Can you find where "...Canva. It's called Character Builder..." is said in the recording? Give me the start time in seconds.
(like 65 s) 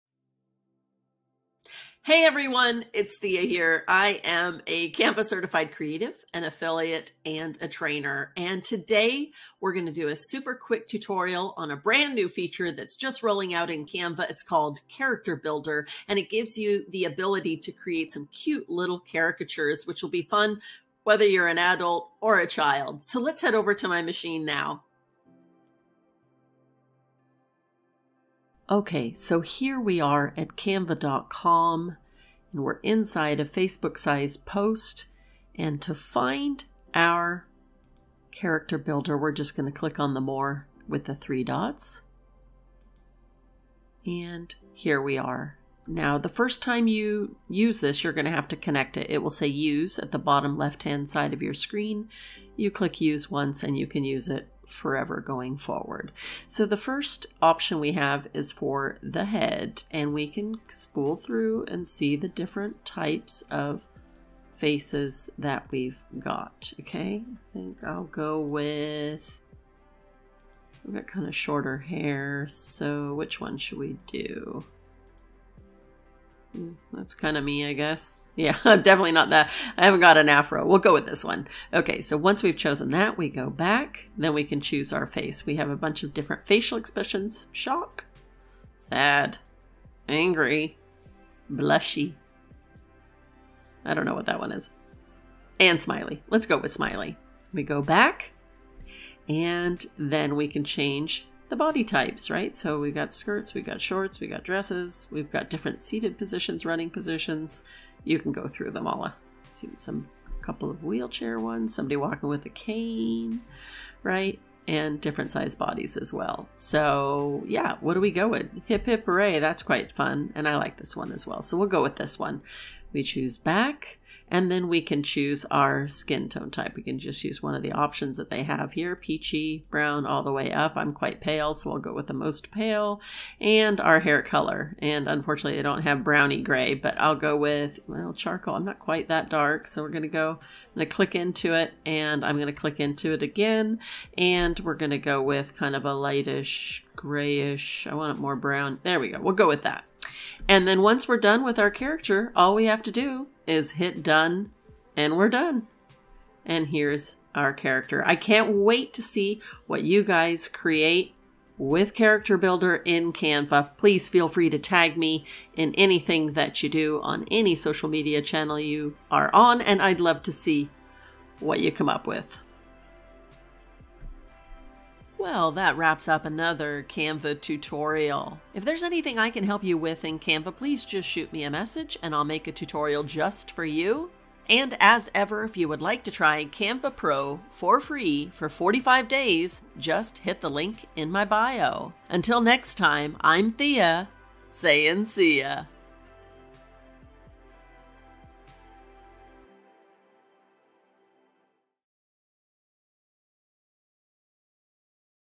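13 s.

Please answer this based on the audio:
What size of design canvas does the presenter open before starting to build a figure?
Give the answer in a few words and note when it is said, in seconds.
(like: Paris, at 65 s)
Facebook size post, at 33 s.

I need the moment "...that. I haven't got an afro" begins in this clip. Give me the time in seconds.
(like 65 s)
79 s.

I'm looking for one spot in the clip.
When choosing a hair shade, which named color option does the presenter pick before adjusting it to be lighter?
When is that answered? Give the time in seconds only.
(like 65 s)
138 s.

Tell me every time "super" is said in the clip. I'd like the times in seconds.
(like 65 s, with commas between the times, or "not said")
10 s.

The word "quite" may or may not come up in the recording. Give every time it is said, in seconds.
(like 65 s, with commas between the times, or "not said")
119 s, 130 s, 138 s.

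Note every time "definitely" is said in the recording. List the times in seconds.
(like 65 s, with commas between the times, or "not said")
78 s.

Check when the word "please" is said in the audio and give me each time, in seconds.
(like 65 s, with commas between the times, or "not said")
163 s, 180 s.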